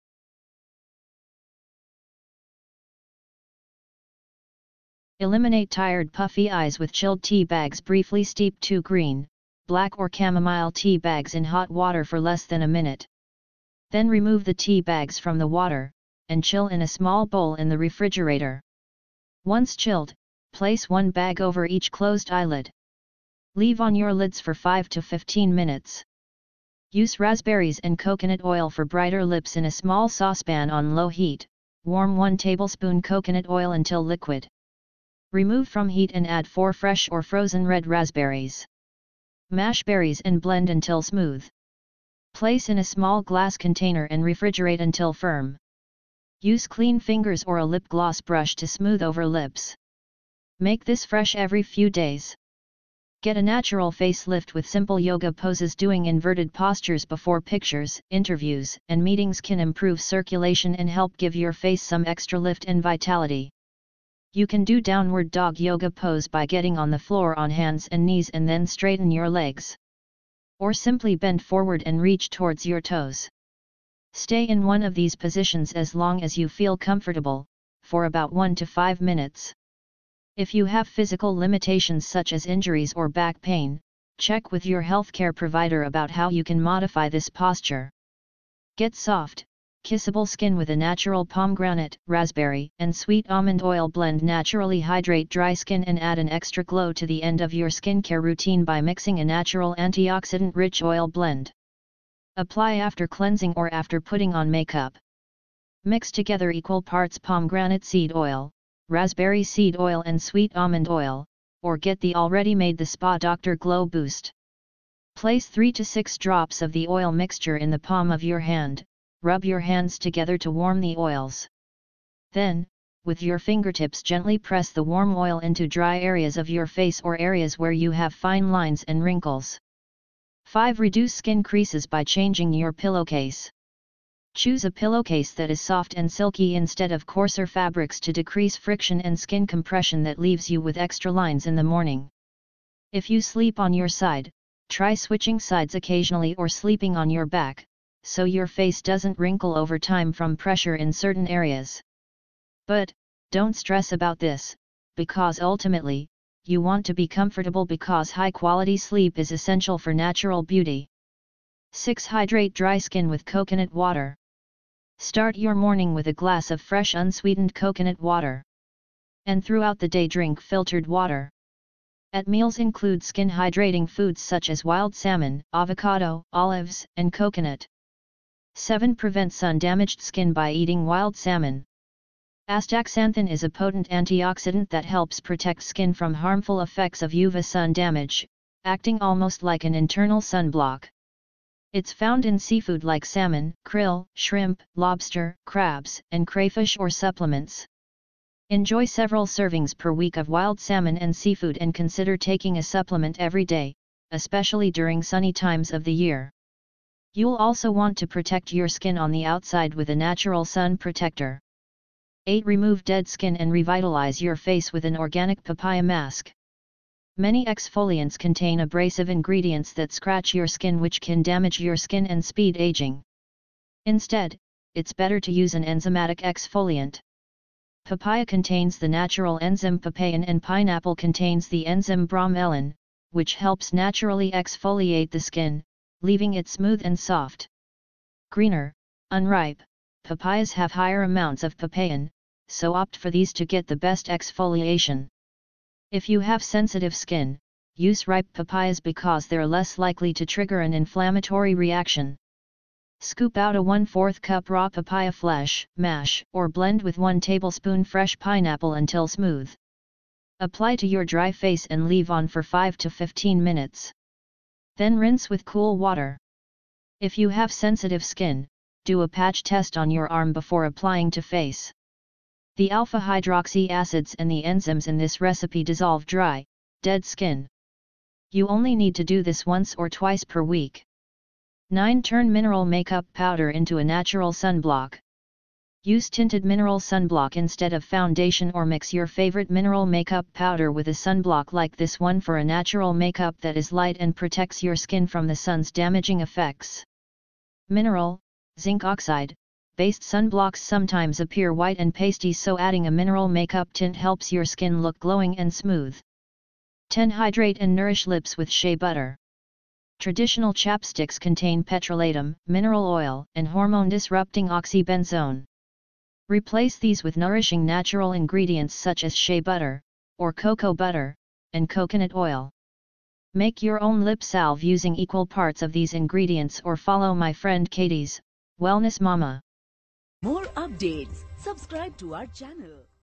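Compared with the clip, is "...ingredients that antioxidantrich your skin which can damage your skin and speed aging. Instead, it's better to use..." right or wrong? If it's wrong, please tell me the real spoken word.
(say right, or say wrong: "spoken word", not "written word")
wrong: "scratch", not "antioxidantrich".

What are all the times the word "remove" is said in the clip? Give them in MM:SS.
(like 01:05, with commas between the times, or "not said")
00:14, 00:35, 03:32.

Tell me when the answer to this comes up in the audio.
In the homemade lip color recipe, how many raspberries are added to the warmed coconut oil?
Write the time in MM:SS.
00:36.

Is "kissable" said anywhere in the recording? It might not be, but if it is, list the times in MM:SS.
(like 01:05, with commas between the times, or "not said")
01:29.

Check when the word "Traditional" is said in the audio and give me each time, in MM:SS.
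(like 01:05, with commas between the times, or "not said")
05:09.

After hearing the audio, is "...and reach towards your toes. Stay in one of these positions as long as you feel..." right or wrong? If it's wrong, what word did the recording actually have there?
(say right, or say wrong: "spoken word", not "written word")
right.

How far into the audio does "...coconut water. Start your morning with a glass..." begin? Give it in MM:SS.
02:43.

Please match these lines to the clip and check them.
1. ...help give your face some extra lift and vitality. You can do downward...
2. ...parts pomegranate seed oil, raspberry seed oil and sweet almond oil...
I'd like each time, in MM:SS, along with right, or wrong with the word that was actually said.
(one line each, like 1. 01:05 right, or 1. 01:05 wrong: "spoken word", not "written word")
1. 01:00 right
2. 01:46 right.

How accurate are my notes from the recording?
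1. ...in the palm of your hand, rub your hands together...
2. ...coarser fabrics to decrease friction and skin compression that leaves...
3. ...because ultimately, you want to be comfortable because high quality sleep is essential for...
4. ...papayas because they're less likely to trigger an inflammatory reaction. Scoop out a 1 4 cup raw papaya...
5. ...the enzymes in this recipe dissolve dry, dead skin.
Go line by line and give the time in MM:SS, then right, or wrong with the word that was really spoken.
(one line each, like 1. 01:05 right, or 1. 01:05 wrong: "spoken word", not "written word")
1. 01:57 right
2. 02:17 right
3. 02:34 right
4. 04:08 right
5. 04:34 right.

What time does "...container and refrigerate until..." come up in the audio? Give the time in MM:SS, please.
00:43.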